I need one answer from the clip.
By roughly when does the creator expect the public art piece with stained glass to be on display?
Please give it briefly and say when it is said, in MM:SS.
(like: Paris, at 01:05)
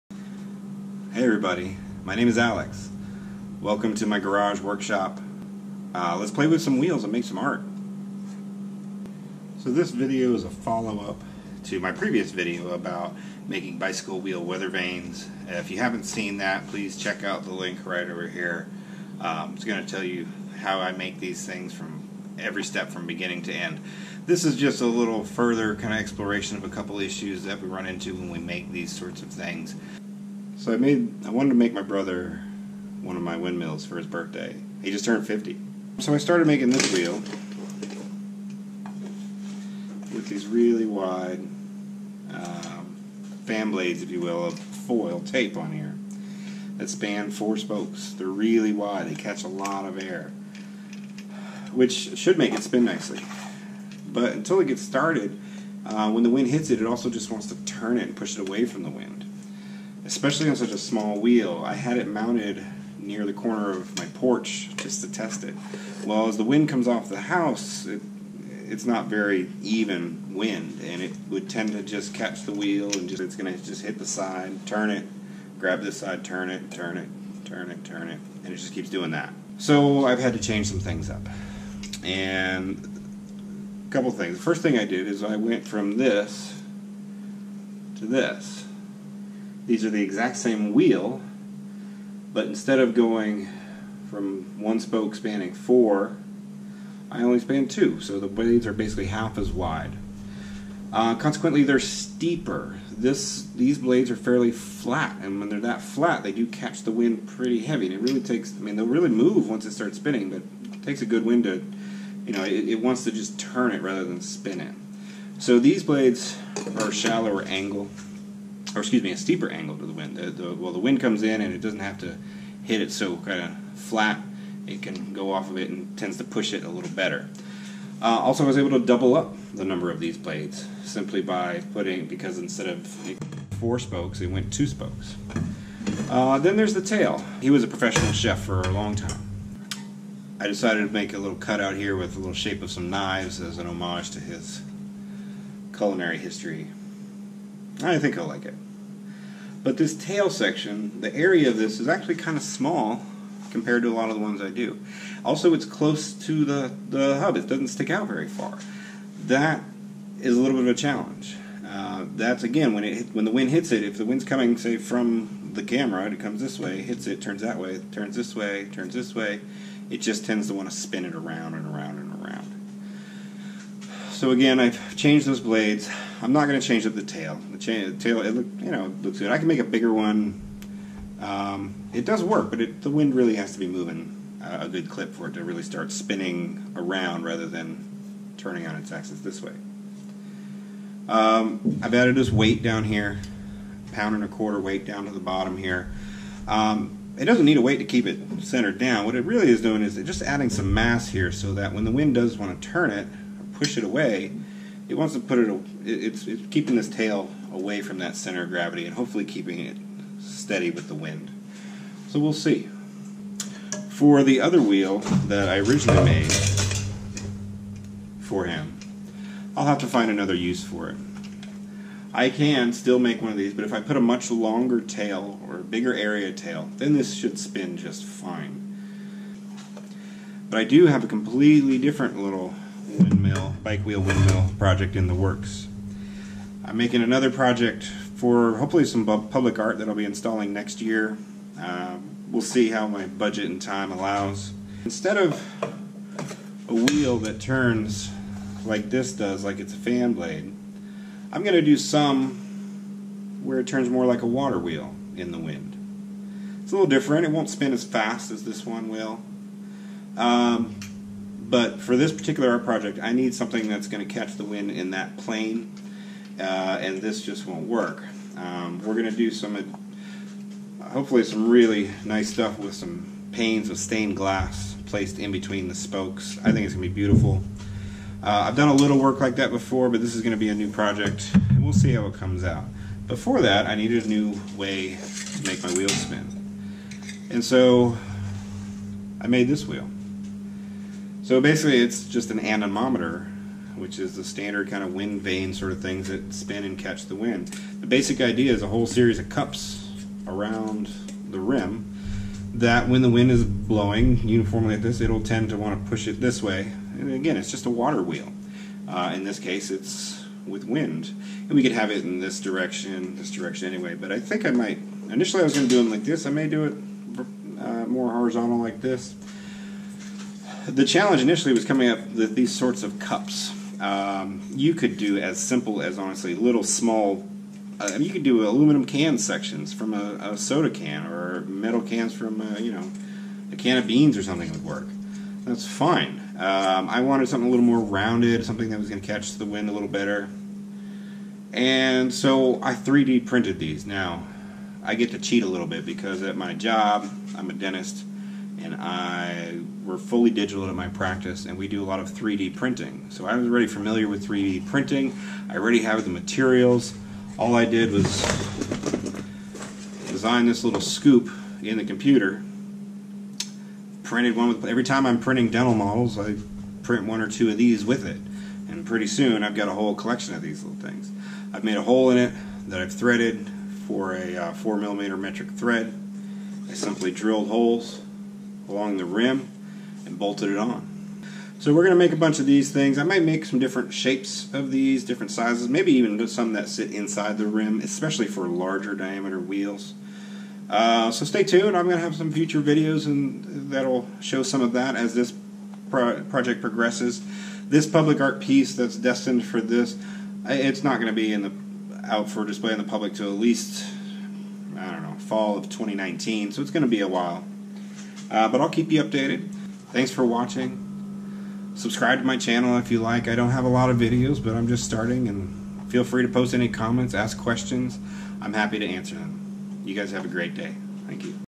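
fall of 2019, at 06:45.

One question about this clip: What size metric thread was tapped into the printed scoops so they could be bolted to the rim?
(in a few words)
4 millimeter.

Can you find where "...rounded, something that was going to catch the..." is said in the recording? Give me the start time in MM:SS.
05:37.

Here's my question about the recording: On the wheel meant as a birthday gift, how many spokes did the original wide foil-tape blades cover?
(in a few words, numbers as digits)
4.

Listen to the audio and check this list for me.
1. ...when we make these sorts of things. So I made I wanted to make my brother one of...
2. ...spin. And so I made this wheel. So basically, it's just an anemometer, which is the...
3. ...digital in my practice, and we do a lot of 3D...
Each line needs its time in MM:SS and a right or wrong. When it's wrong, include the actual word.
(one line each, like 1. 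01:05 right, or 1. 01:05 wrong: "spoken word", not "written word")
1. 00:28 right
2. 04:45 right
3. 05:50 right.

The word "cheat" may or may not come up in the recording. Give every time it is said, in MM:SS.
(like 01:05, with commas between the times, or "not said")
05:45.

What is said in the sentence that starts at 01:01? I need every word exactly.
I had it mounted near the corner of my porch just to test it.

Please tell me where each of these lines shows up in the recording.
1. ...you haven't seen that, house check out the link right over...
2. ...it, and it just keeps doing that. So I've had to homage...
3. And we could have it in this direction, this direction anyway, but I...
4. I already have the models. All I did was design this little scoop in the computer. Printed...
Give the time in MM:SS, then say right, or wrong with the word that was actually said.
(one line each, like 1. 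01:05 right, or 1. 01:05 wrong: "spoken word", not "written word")
1. 00:15 wrong: "please", not "house"
2. 01:18 wrong: "change", not "homage"
3. 05:11 right
4. 05:55 wrong: "materials", not "models".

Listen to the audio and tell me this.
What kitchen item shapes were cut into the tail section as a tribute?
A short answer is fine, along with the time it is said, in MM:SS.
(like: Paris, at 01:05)
knives, at 02:22.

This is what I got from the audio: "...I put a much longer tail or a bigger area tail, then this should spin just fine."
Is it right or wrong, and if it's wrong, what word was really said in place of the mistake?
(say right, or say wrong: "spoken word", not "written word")
right.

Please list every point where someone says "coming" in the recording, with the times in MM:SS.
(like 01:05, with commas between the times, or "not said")
02:44, 05:21.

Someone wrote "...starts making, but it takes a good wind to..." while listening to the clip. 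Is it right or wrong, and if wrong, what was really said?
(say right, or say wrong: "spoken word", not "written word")
wrong: "spinning", not "making".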